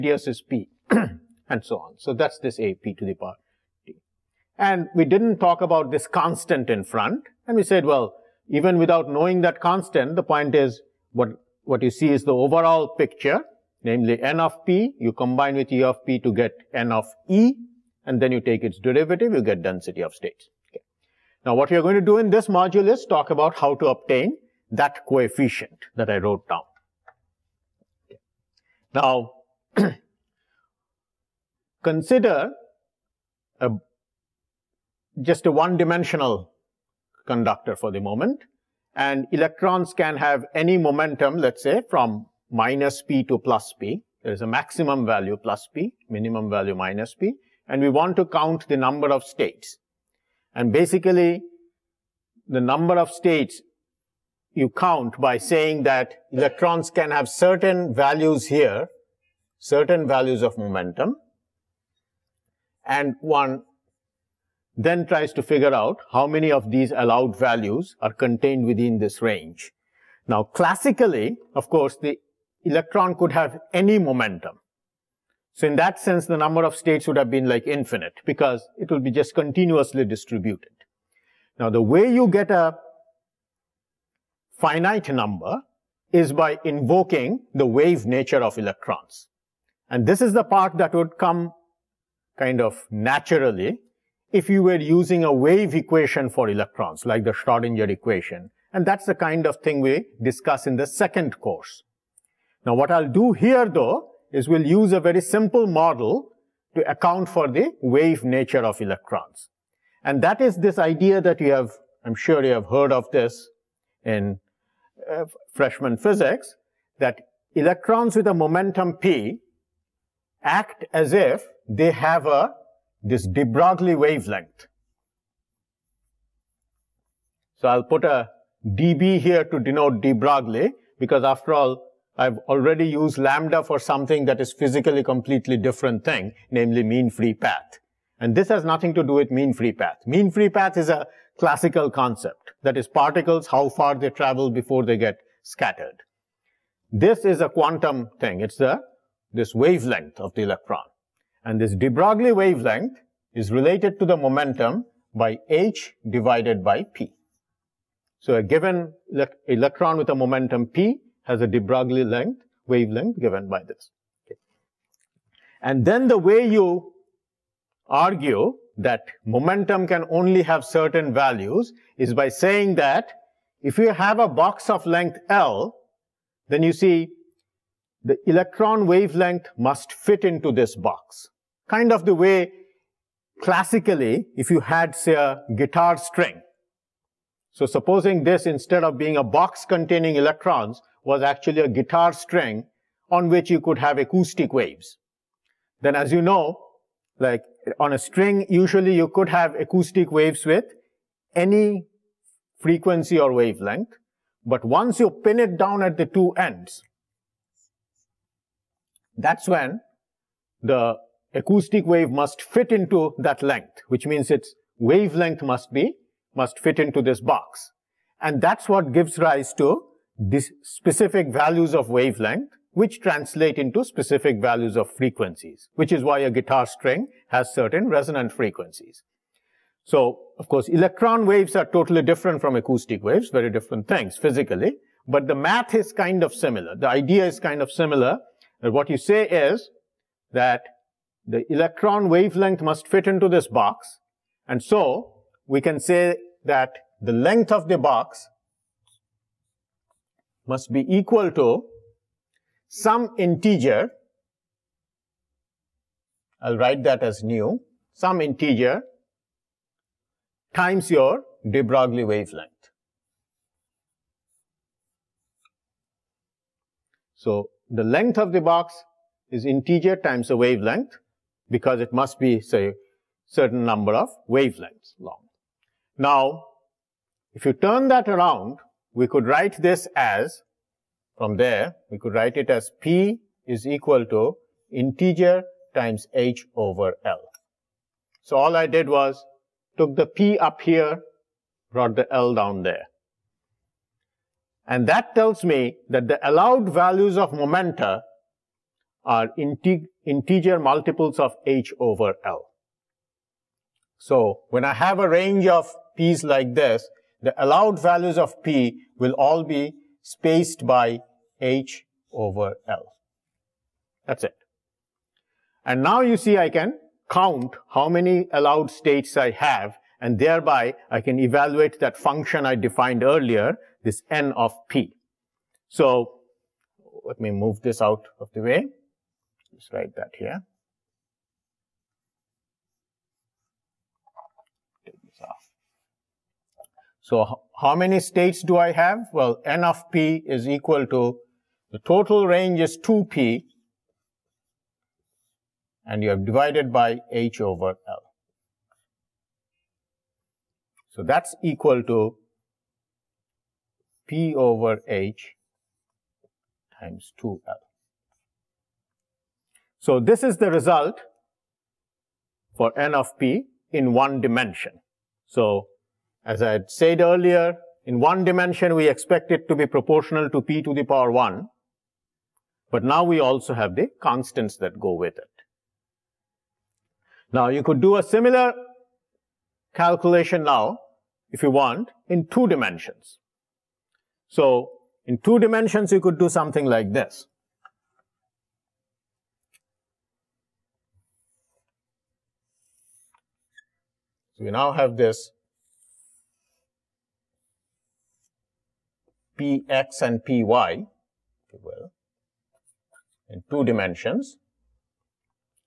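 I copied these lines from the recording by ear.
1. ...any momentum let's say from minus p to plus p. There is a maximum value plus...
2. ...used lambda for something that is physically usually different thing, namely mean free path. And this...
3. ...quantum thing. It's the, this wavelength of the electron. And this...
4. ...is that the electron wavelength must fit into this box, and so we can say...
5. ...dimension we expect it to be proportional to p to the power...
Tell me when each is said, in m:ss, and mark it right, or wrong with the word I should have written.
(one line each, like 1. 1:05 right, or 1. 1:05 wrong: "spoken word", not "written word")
1. 0:40 right
2. 2:12 wrong: "completely", not "usually"
3. 2:27 right
4. 3:59 right
5. 6:08 right.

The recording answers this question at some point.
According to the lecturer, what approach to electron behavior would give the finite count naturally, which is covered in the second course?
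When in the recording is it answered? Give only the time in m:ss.
1:37.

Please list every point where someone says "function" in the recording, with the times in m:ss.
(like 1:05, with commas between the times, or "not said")
5:21.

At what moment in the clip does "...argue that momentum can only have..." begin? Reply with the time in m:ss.
2:47.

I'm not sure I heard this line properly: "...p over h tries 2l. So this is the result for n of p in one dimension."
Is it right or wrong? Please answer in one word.
wrong.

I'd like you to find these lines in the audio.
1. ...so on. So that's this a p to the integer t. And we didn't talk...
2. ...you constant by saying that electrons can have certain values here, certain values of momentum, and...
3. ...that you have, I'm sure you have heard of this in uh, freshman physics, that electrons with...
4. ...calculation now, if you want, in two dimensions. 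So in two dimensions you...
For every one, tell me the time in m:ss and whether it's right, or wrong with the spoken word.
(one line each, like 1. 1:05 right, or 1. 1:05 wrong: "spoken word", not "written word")
1. 0:01 wrong: "power", not "integer"
2. 0:54 wrong: "count", not "constant"
3. 1:51 right
4. 6:19 right.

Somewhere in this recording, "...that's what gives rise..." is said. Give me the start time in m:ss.
3:38.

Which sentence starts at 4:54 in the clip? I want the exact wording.
And that tells me that the allowed values of momenta are integ integer multiples of H over L.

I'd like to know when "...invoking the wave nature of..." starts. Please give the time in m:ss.
1:26.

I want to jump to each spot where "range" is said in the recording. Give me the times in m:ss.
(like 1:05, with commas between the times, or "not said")
1:09, 5:05, 5:42.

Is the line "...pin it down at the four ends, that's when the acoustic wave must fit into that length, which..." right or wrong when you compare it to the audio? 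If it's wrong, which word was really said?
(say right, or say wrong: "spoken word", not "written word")
wrong: "two", not "four".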